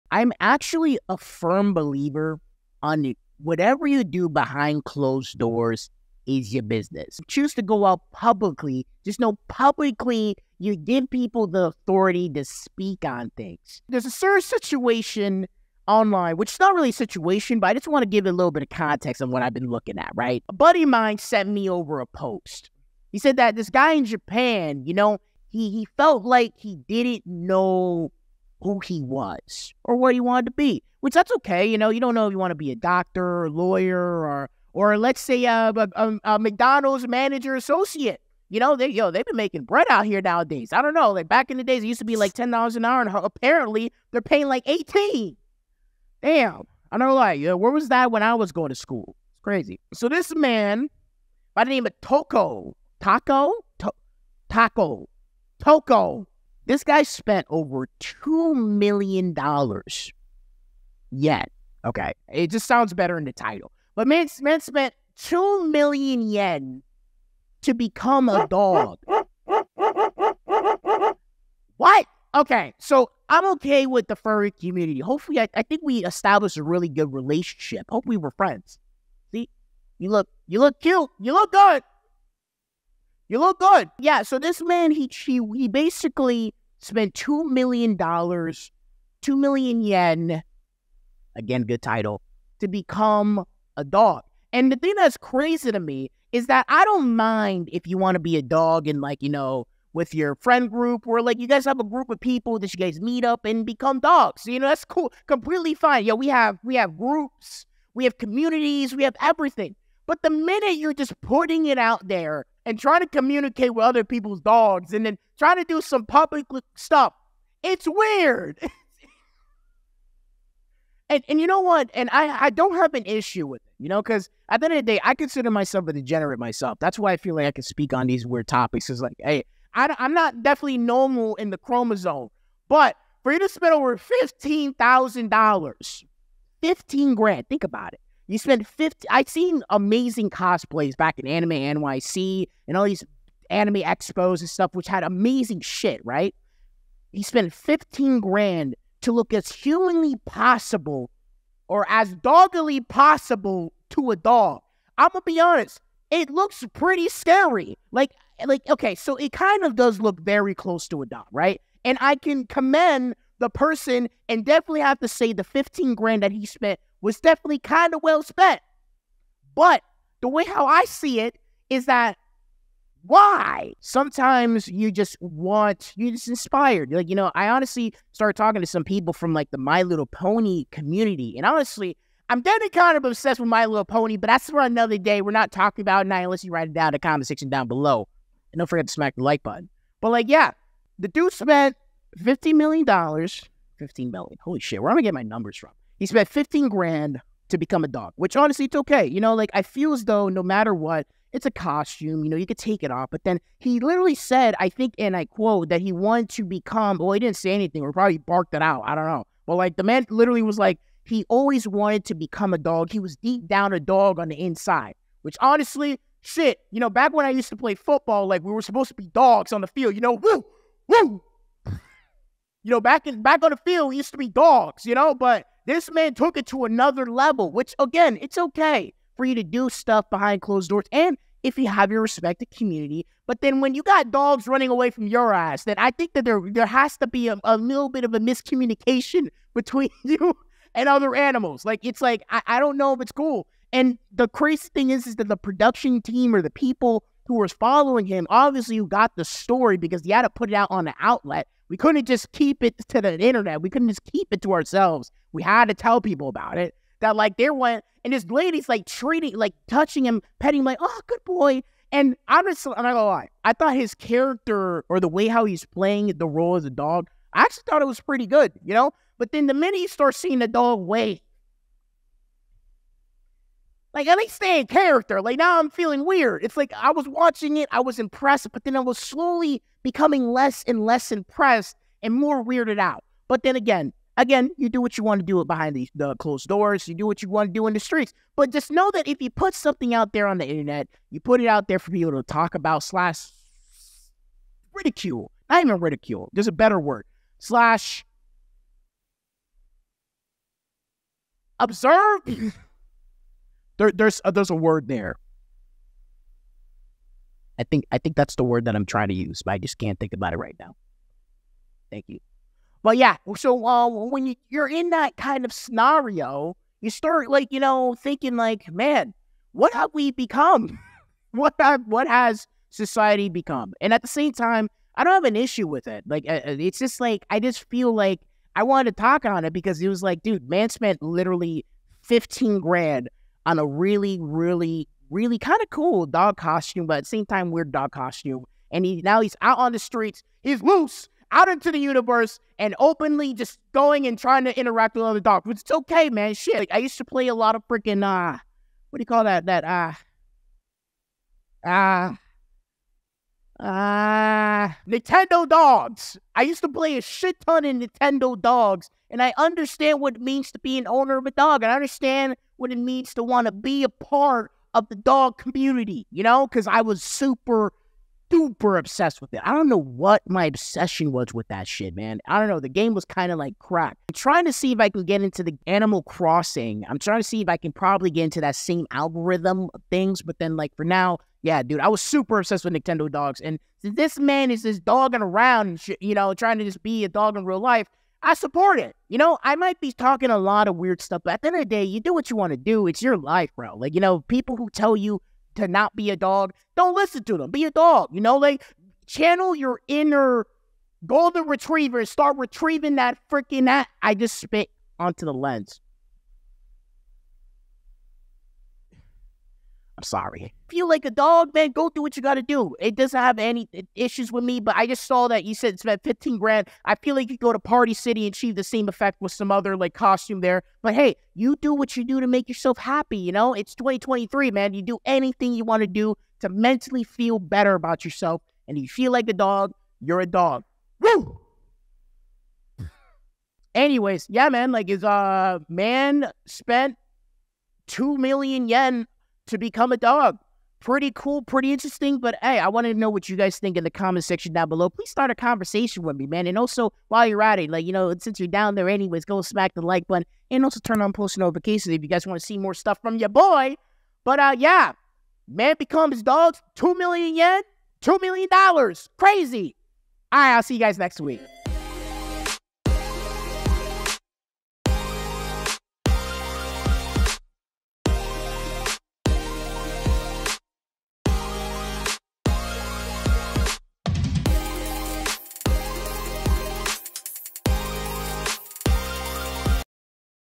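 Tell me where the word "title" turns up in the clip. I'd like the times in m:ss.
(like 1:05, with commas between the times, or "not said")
1:03, 1:31.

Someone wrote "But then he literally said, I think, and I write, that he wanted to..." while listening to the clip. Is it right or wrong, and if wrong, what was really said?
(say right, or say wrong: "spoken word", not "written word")
wrong: "quote", not "write".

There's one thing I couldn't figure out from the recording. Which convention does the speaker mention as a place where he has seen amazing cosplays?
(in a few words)
Anime NYC.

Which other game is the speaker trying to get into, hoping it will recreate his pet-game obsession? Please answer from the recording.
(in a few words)
Animal Crossing.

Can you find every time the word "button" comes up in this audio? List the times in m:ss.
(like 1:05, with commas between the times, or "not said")
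3:09, 7:30.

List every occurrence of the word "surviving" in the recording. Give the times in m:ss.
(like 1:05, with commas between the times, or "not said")
not said.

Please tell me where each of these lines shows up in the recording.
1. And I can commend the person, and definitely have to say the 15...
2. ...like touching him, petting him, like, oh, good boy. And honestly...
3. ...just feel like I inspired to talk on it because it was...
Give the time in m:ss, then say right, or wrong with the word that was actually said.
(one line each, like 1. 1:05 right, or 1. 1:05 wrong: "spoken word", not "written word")
1. 2:41 right
2. 4:19 right
3. 5:27 wrong: "wanted", not "inspired".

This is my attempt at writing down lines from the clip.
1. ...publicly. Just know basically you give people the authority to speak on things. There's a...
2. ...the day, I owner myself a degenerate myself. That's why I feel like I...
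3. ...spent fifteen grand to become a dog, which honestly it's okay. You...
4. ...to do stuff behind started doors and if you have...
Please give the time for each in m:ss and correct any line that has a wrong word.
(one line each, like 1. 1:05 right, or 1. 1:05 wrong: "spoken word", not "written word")
1. 0:08 wrong: "publicly", not "basically"
2. 2:04 wrong: "consider", not "owner"
3. 3:16 right
4. 3:49 wrong: "closed", not "started".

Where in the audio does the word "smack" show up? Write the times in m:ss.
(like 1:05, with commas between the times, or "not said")
3:08, 7:29.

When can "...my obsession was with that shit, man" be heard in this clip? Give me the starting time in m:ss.
6:10.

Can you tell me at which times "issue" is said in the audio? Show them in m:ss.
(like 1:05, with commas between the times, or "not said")
2:03, 5:25, 6:53.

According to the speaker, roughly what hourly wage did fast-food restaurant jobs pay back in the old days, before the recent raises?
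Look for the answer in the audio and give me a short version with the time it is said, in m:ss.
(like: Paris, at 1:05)
$10 an hour, at 0:42.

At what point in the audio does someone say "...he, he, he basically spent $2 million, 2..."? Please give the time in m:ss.
1:24.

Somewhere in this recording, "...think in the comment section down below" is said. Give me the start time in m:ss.
7:23.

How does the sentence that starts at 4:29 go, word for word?
But then the minute you start seeing the dog wait like, and they stay in character.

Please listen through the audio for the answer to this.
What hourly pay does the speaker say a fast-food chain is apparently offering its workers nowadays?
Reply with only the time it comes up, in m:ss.
0:44.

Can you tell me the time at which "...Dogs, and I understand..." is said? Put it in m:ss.
5:58.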